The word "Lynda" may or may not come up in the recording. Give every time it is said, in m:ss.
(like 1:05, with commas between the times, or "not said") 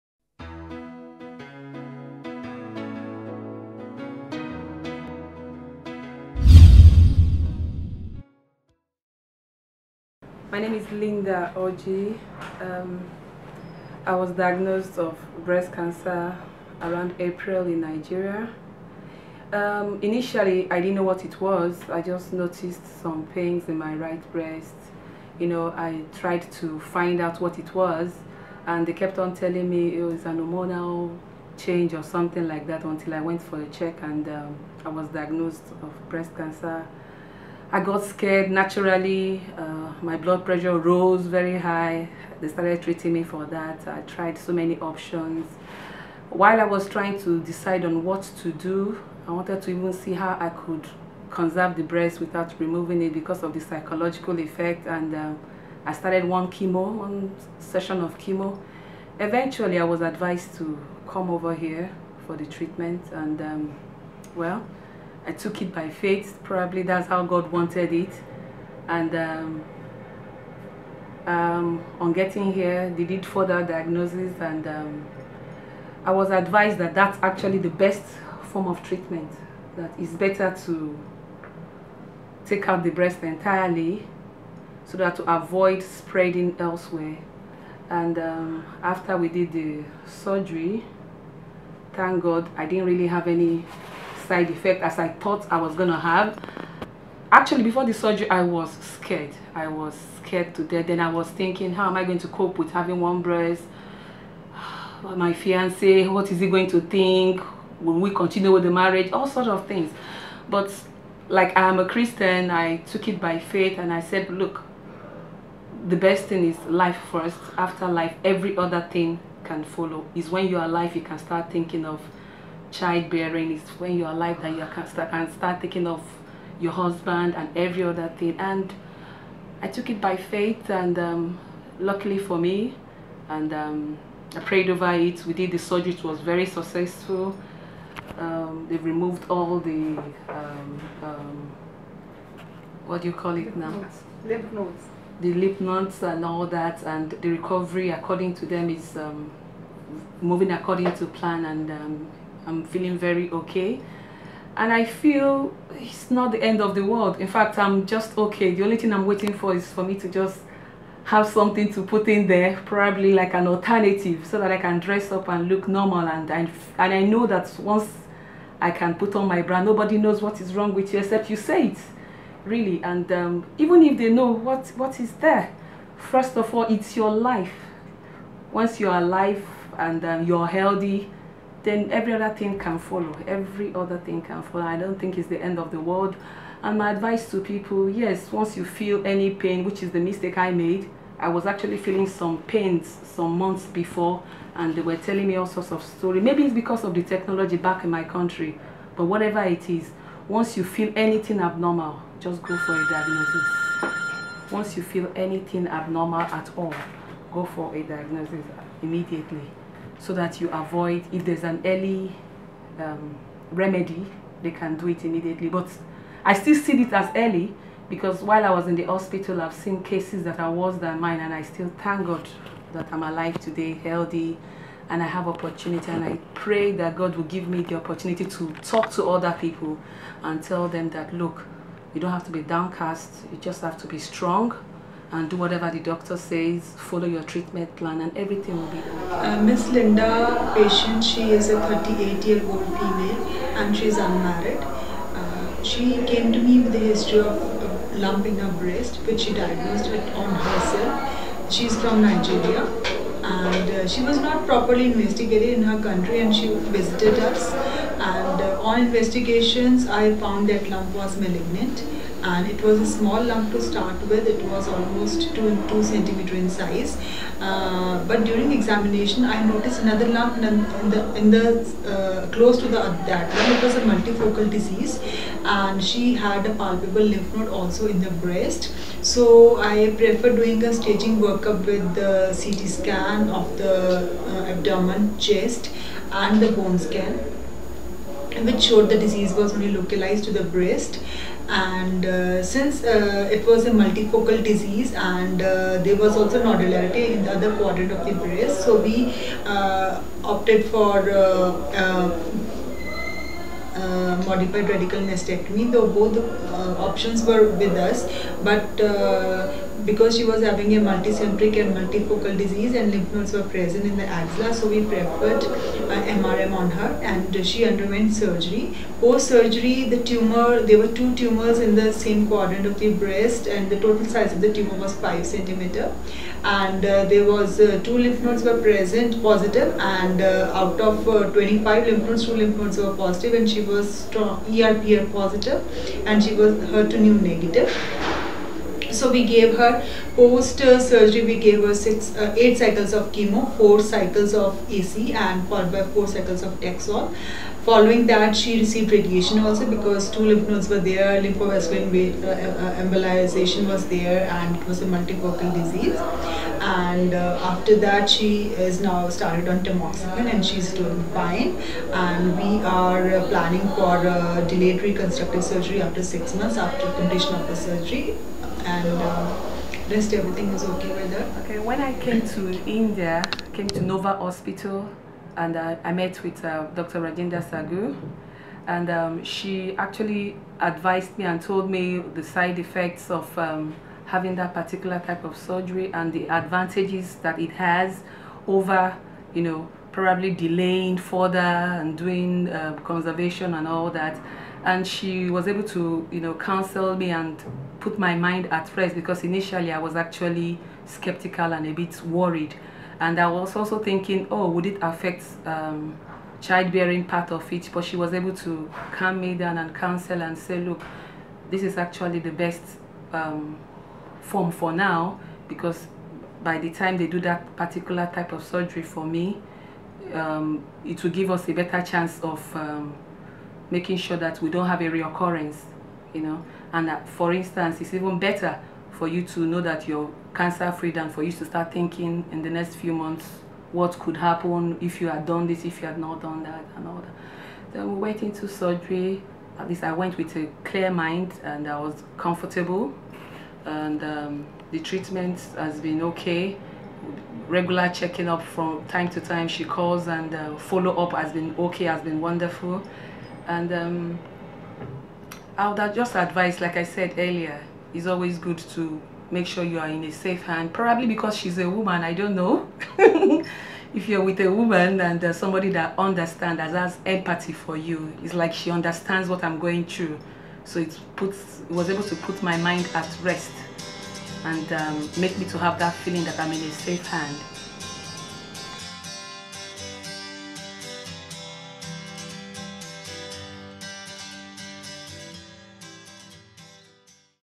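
0:10, 3:59.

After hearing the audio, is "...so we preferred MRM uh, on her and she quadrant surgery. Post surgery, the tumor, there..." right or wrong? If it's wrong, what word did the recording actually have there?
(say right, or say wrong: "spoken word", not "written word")
wrong: "underwent", not "quadrant".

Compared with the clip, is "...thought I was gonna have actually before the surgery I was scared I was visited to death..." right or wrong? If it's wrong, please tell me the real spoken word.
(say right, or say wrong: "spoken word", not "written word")
wrong: "scared", not "visited".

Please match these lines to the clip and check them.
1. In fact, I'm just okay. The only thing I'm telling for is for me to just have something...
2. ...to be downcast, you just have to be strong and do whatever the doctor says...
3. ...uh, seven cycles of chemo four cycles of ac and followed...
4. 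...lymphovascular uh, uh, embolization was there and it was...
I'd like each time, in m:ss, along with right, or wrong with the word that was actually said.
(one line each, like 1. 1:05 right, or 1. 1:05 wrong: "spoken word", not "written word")
1. 2:37 wrong: "waiting", not "telling"
2. 3:52 right
3. 5:42 wrong: "eight", not "seven"
4. 5:51 right.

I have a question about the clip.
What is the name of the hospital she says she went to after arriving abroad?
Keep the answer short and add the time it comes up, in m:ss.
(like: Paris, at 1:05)
Nova Hospital, at 6:13.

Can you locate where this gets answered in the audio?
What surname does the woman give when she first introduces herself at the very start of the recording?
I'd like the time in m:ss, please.
0:11.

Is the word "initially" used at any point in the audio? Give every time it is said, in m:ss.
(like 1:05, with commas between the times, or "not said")
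0:20, 6:39.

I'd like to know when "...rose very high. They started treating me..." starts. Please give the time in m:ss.
0:40.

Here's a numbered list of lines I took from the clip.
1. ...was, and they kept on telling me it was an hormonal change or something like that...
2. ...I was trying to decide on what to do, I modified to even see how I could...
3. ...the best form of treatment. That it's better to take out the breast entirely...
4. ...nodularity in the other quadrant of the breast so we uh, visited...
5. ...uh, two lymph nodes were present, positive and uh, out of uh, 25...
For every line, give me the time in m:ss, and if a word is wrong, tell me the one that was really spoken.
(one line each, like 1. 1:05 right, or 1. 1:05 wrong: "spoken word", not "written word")
1. 0:27 right
2. 0:46 wrong: "wanted", not "modified"
3. 1:17 right
4. 4:56 wrong: "opted", not "visited"
5. 5:27 right.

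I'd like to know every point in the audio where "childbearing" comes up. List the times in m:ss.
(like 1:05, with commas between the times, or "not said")
2:02, 6:46.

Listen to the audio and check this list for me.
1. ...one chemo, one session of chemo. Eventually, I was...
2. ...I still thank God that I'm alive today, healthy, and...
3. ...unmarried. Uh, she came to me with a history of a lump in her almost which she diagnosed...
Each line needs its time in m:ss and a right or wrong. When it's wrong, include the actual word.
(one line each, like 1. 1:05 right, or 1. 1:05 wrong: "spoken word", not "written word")
1. 0:56 right
2. 3:41 right
3. 4:03 wrong: "breast", not "almost".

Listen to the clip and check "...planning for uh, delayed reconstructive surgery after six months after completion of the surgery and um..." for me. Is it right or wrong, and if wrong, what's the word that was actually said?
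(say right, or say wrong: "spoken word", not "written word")
right.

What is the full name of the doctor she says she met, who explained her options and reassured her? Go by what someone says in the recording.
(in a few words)
Rajinder Saggu.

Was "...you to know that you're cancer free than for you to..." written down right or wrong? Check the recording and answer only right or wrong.
right.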